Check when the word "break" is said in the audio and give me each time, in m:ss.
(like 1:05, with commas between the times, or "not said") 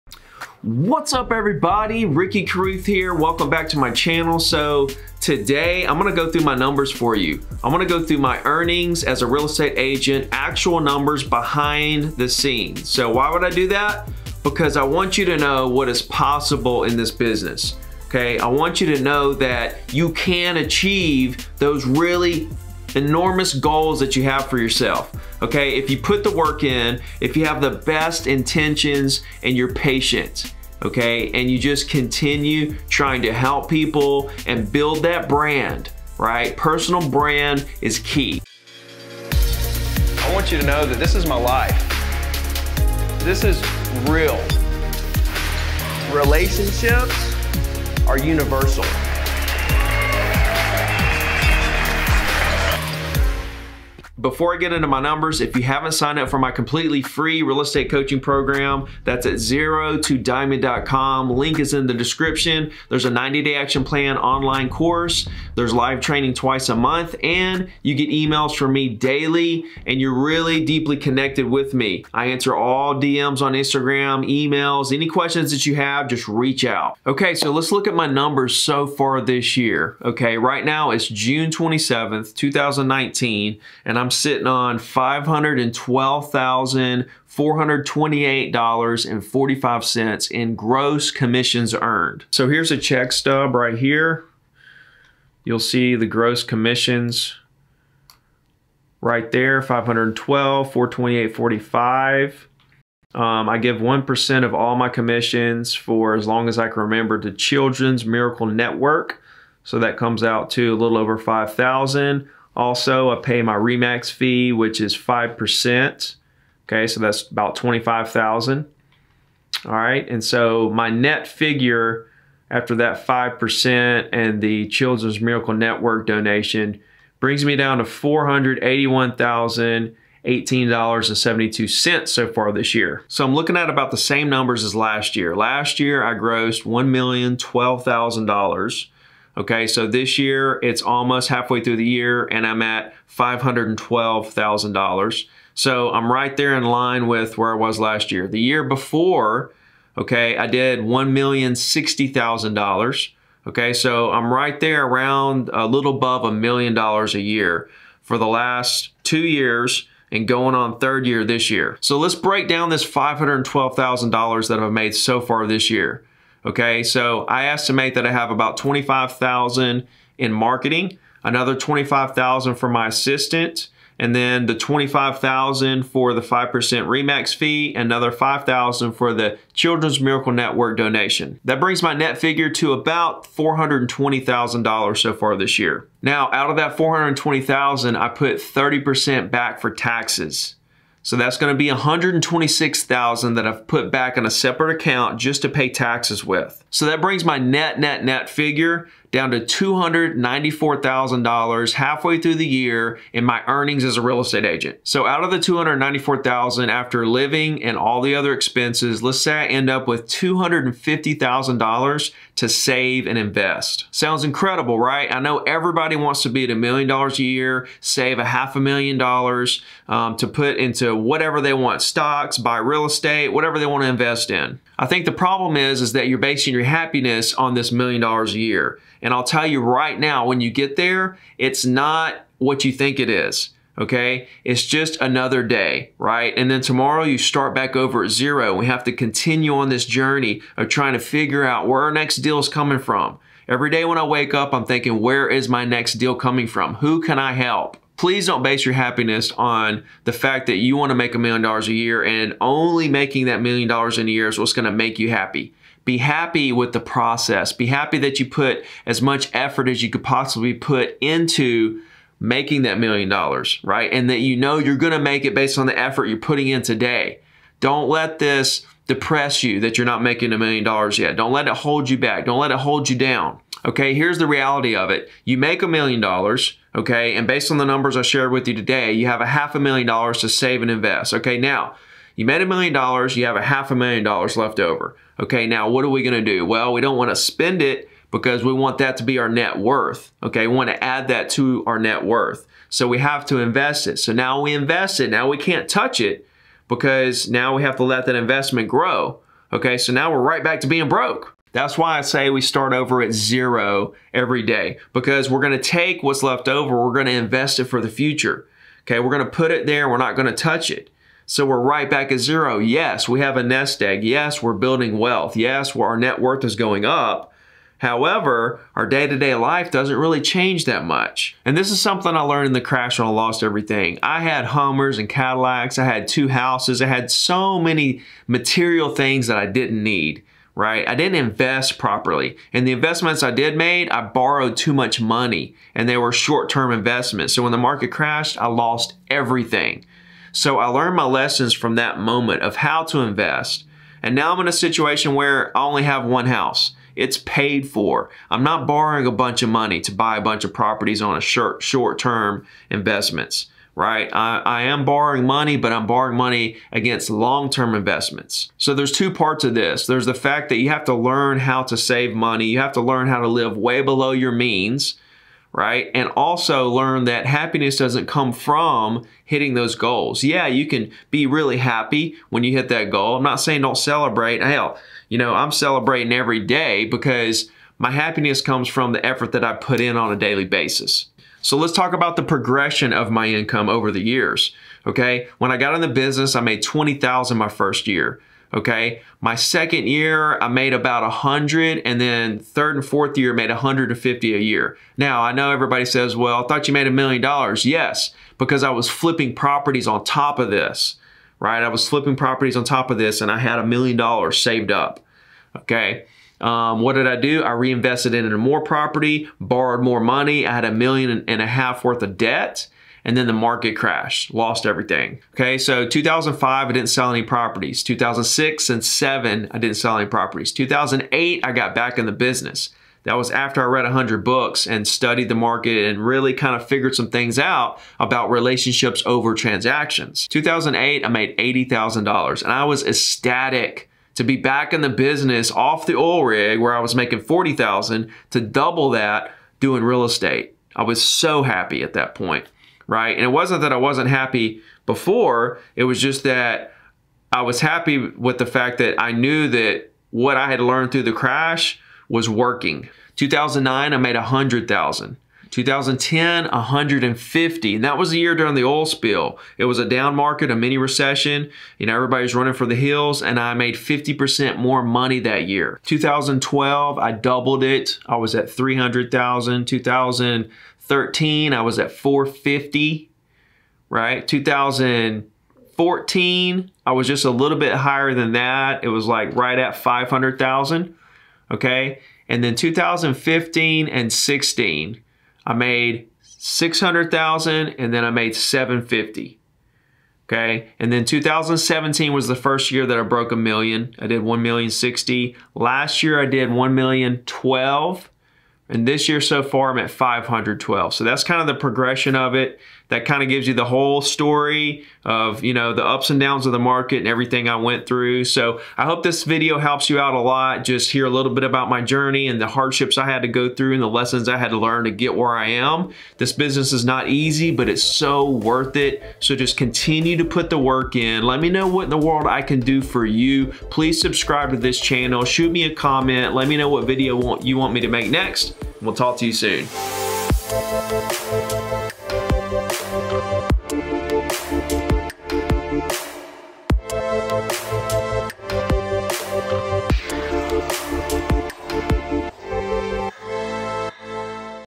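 2:42.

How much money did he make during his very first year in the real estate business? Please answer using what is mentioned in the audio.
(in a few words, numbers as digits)
20,000.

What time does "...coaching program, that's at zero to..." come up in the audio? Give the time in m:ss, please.
0:57.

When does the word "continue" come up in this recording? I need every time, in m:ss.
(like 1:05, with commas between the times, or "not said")
0:31, 3:58, 8:39.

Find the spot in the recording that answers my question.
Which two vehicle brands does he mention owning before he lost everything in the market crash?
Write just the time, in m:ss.
5:24.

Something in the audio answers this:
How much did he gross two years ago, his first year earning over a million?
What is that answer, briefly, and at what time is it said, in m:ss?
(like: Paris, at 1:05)
$1,060,000, at 2:30.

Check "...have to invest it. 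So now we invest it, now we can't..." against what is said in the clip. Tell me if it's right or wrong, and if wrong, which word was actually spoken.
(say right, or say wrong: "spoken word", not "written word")
right.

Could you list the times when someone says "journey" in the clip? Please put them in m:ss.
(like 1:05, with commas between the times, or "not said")
3:59, 8:31.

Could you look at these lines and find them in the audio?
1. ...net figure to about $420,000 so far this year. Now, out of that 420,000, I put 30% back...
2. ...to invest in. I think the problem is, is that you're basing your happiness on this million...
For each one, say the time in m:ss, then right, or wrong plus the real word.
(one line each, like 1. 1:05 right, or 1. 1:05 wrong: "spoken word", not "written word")
1. 3:01 right
2. 3:43 right.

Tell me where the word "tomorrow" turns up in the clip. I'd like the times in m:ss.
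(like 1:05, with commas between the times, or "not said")
3:56.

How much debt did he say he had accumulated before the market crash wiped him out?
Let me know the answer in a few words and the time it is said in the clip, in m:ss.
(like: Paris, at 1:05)
a million and a half, at 6:50.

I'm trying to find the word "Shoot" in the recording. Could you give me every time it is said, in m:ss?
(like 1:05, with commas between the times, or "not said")
8:45.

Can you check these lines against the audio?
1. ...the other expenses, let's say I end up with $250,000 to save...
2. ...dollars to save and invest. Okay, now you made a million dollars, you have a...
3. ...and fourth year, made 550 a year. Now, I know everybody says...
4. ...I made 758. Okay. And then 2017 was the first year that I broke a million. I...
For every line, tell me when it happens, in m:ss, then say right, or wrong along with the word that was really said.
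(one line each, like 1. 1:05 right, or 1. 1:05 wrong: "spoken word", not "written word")
1. 3:28 right
2. 4:39 right
3. 6:32 wrong: "150", not "550"
4. 8:08 wrong: "750", not "758".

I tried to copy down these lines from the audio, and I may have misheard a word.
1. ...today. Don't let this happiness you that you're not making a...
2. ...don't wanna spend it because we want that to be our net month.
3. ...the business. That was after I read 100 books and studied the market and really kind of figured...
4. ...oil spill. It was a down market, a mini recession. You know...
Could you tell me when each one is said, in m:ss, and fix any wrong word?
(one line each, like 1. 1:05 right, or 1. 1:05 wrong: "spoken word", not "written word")
1. 4:26 wrong: "depress", not "happiness"
2. 4:46 wrong: "worth", not "month"
3. 7:02 right
4. 7:38 right.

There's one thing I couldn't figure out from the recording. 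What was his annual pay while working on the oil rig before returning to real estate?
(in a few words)
40,000.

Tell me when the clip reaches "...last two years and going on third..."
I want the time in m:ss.
2:38.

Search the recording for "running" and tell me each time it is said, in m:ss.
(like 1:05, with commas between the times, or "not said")
7:42.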